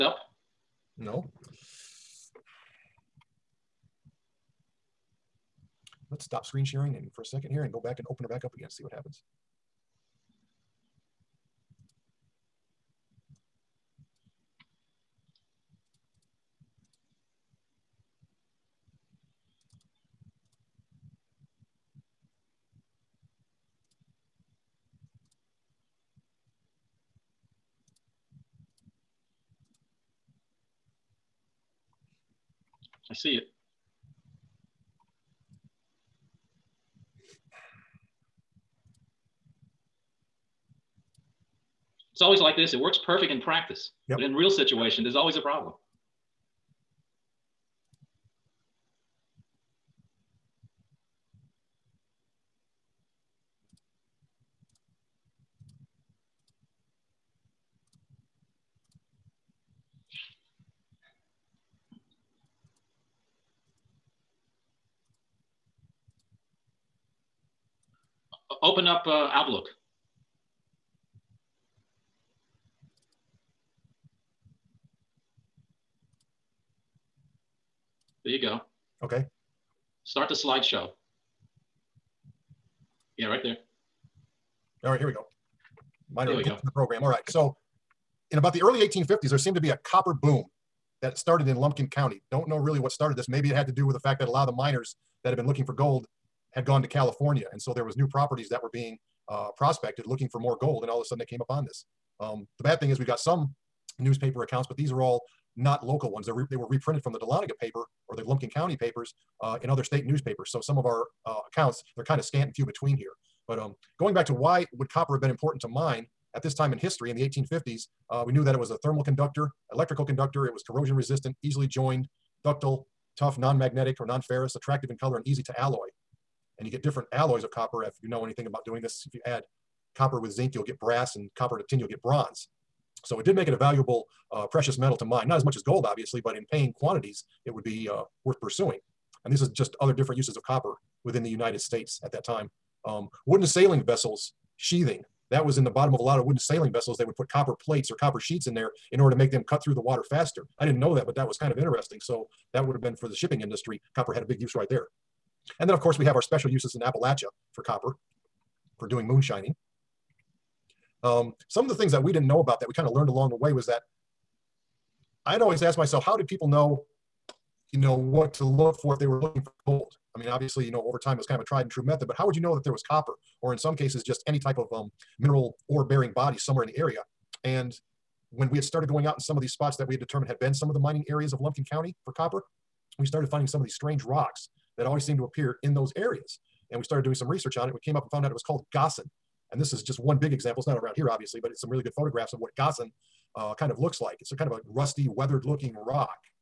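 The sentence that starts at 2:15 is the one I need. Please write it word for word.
Not as much as gold, obviously, but in paying quantities, it would be uh, worth pursuing.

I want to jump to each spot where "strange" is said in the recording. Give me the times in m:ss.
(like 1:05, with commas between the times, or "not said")
3:03.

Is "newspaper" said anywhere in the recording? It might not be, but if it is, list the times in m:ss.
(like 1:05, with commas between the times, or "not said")
1:43, 1:50.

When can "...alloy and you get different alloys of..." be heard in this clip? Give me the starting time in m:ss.
2:05.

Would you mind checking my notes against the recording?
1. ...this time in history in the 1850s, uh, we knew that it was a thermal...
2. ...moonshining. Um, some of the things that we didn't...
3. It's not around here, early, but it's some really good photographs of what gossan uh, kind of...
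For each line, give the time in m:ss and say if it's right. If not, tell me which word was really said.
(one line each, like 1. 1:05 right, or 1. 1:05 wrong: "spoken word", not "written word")
1. 1:56 right
2. 2:39 right
3. 3:10 wrong: "obviously", not "early".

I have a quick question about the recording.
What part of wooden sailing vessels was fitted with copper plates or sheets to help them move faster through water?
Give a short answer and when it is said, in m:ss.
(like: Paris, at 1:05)
The bottom, at 2:25.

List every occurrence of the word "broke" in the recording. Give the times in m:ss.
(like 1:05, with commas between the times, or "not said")
not said.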